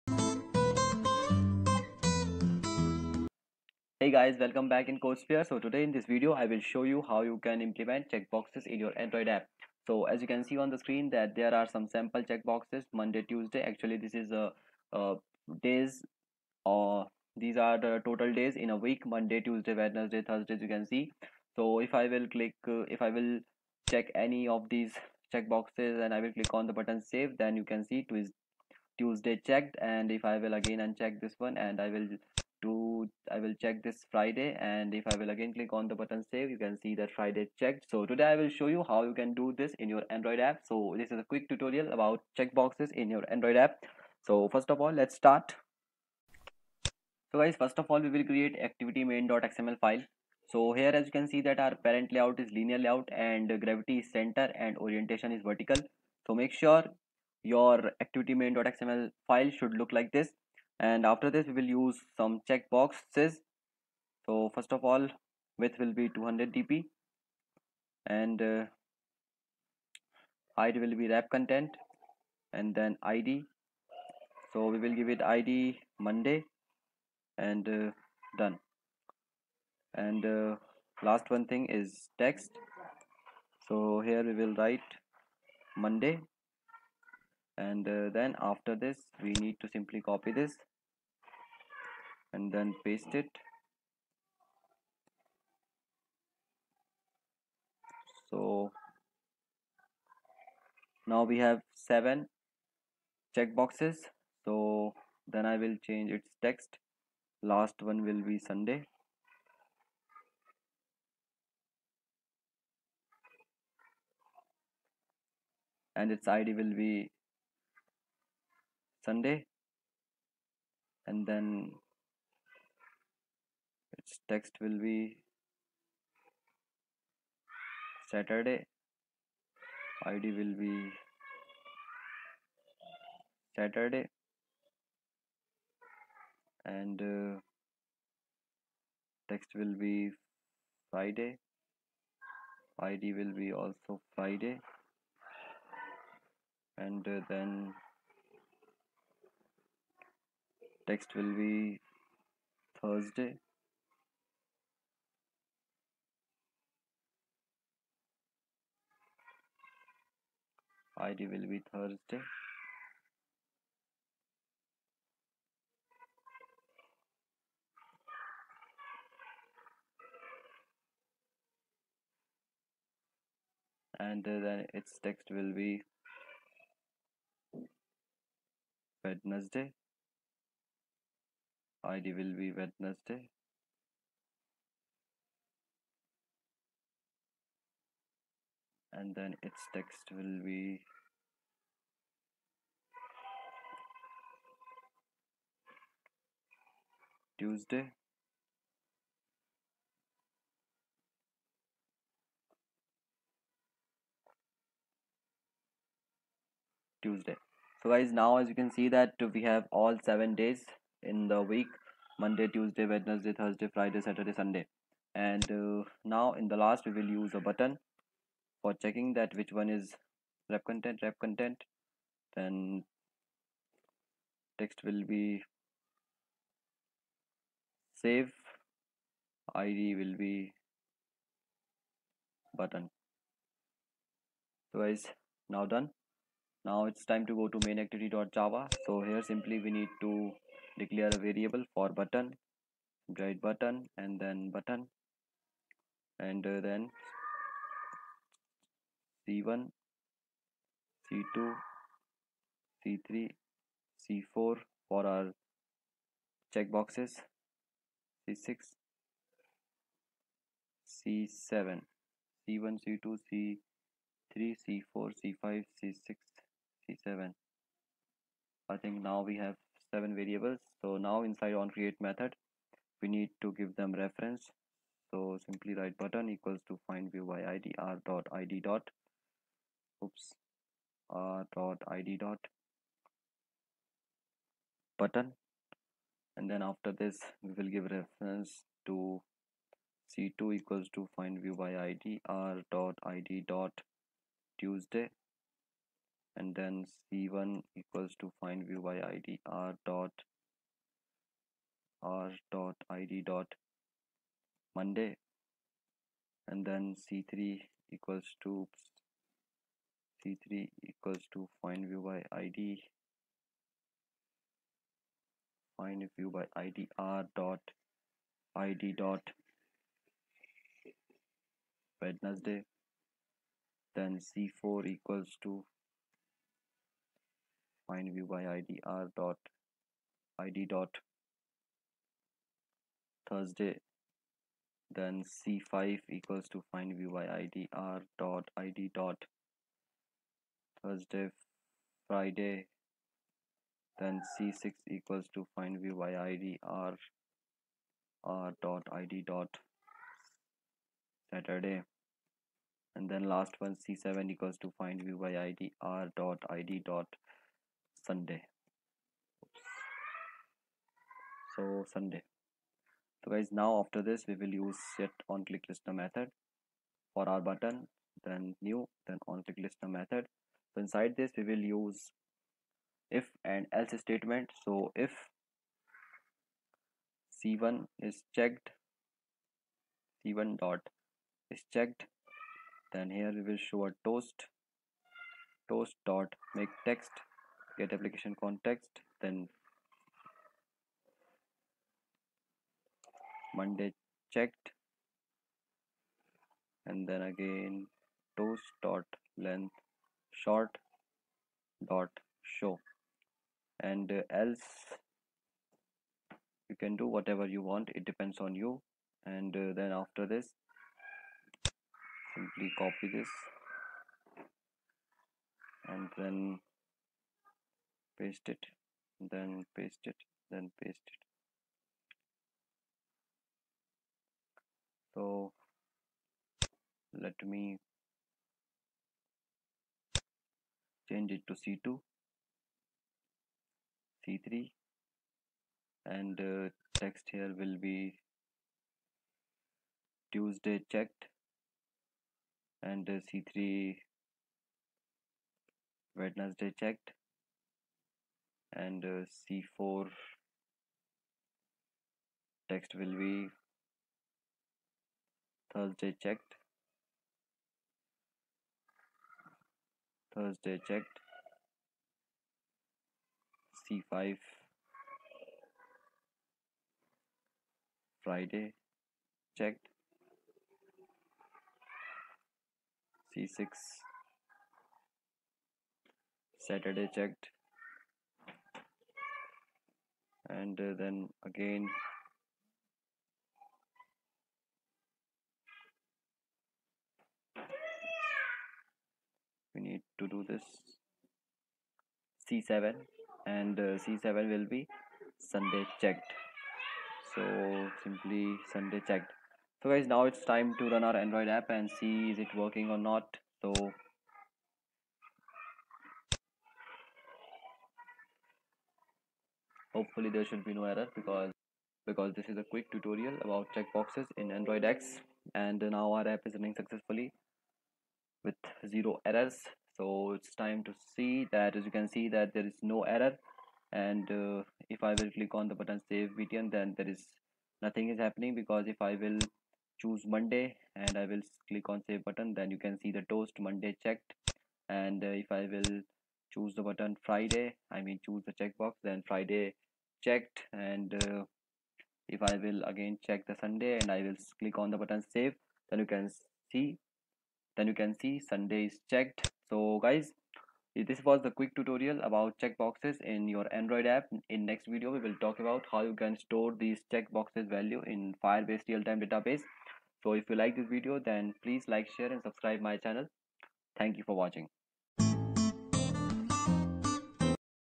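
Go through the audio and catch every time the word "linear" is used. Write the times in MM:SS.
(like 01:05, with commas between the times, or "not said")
00:52.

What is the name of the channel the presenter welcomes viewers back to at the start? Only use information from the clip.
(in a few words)
CodeSphere.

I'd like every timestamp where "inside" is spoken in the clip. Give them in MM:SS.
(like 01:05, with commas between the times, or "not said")
04:31, 06:10.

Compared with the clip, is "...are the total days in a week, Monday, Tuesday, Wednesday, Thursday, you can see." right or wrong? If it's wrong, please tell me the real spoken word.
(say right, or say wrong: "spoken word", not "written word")
right.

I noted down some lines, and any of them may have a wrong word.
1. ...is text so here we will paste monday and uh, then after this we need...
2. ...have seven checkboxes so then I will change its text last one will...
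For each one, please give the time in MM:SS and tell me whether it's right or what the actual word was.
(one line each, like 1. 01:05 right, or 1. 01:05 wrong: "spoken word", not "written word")
1. 01:21 wrong: "write", not "paste"
2. 01:41 right.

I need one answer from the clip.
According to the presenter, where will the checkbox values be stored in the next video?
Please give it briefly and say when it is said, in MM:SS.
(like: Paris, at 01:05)
Firebase real-time database, at 09:18.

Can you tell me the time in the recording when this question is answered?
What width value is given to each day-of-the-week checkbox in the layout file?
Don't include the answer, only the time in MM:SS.
01:06.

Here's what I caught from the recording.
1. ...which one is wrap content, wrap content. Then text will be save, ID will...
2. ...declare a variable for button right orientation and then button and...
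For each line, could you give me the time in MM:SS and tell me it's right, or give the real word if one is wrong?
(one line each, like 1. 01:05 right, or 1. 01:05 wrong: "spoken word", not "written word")
1. 03:39 right
2. 04:00 wrong: "button", not "orientation".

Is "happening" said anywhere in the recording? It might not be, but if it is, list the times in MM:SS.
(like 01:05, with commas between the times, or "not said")
08:48.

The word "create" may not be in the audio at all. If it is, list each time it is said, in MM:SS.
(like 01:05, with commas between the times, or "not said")
00:48, 04:31.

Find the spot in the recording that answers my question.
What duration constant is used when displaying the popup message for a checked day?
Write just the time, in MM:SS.
06:39.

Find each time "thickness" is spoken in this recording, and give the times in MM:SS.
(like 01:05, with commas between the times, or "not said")
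not said.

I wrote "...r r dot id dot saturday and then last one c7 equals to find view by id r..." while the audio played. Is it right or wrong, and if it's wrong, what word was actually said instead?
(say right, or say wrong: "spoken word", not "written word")
right.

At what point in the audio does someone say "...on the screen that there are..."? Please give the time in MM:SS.
00:10.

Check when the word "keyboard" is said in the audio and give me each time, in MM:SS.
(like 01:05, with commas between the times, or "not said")
not said.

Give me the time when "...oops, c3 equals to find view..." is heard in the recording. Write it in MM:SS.
05:08.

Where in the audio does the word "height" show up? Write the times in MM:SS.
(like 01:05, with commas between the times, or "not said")
01:10.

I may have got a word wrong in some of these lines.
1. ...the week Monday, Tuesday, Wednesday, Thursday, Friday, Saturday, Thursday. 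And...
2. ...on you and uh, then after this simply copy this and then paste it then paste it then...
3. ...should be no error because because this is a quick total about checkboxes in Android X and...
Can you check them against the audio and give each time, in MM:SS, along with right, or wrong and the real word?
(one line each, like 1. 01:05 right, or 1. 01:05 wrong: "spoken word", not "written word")
1. 03:31 wrong: "Sunday", not "Thursday"
2. 06:48 right
3. 08:30 wrong: "tutorial", not "total".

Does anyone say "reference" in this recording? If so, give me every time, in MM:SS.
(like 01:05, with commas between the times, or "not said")
04:33, 04:47.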